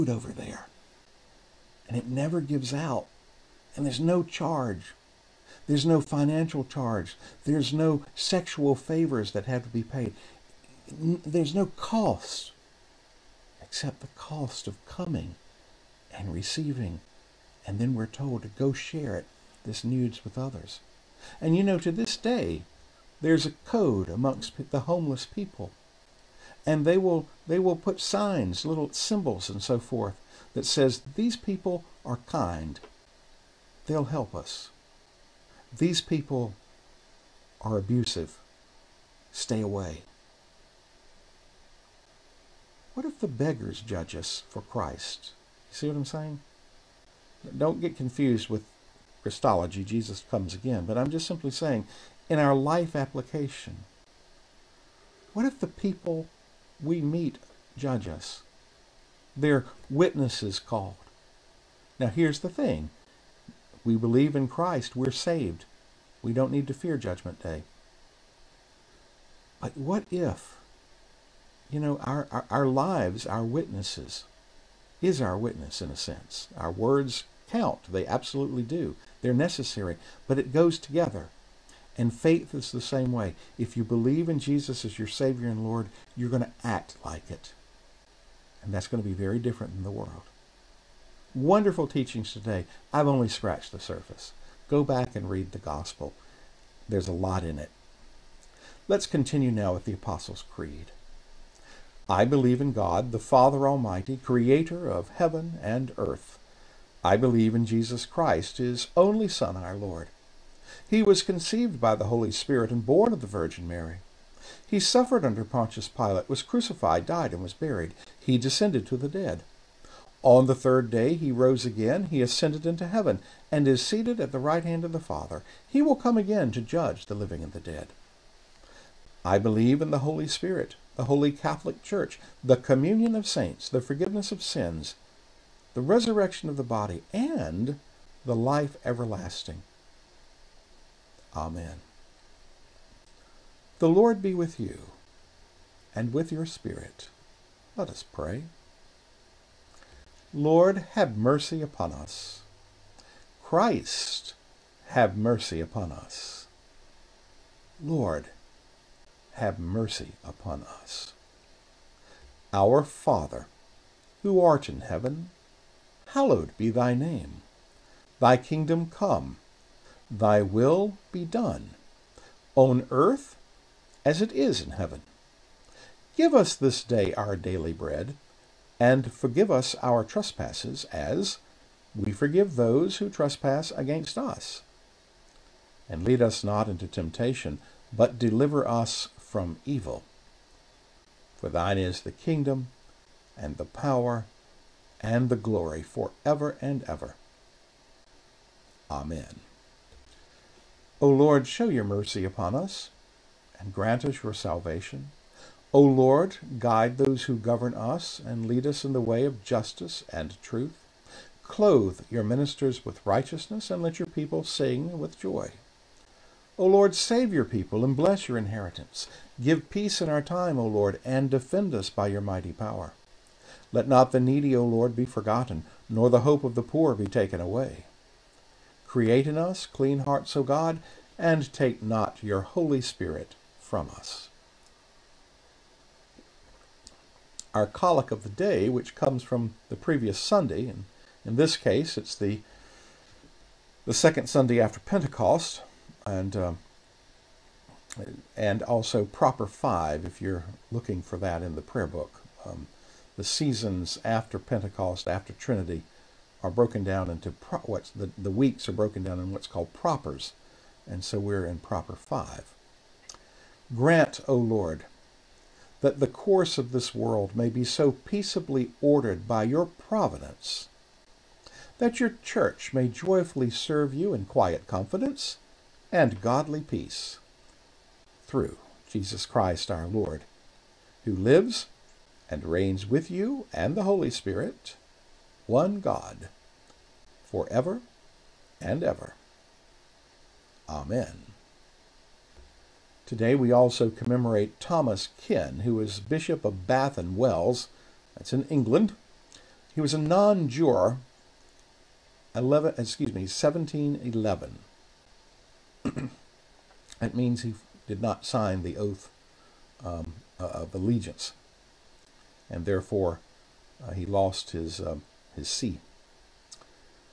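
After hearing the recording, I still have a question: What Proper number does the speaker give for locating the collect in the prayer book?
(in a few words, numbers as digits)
Proper 5.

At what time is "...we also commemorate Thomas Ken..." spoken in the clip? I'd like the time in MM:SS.
04:53.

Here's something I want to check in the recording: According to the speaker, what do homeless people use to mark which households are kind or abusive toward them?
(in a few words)
Little symbols.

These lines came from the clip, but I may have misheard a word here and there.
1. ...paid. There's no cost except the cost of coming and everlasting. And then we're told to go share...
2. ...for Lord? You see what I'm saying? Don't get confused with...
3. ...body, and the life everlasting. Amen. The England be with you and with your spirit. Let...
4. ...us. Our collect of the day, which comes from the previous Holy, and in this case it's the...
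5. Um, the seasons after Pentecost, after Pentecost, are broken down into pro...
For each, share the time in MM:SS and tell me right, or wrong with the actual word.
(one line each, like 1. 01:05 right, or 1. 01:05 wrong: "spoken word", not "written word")
1. 00:09 wrong: "receiving", not "everlasting"
2. 00:44 wrong: "Christ", not "Lord"
3. 02:16 wrong: "Lord", not "England"
4. 03:53 wrong: "Sunday", not "Holy"
5. 04:12 wrong: "Trinity", not "Pentecost".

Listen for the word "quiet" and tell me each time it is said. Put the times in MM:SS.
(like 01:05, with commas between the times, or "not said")
04:34.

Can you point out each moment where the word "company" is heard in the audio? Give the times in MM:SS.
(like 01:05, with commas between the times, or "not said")
not said.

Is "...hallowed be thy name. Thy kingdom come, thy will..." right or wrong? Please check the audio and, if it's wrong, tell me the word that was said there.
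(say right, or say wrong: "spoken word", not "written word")
right.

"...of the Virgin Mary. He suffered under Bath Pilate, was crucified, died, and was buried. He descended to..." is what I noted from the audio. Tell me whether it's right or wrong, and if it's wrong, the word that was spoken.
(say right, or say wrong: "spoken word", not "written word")
wrong: "Pontius", not "Bath".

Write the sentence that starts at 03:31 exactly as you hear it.
Clothe your ministers with righteousness and let your people sing with joy.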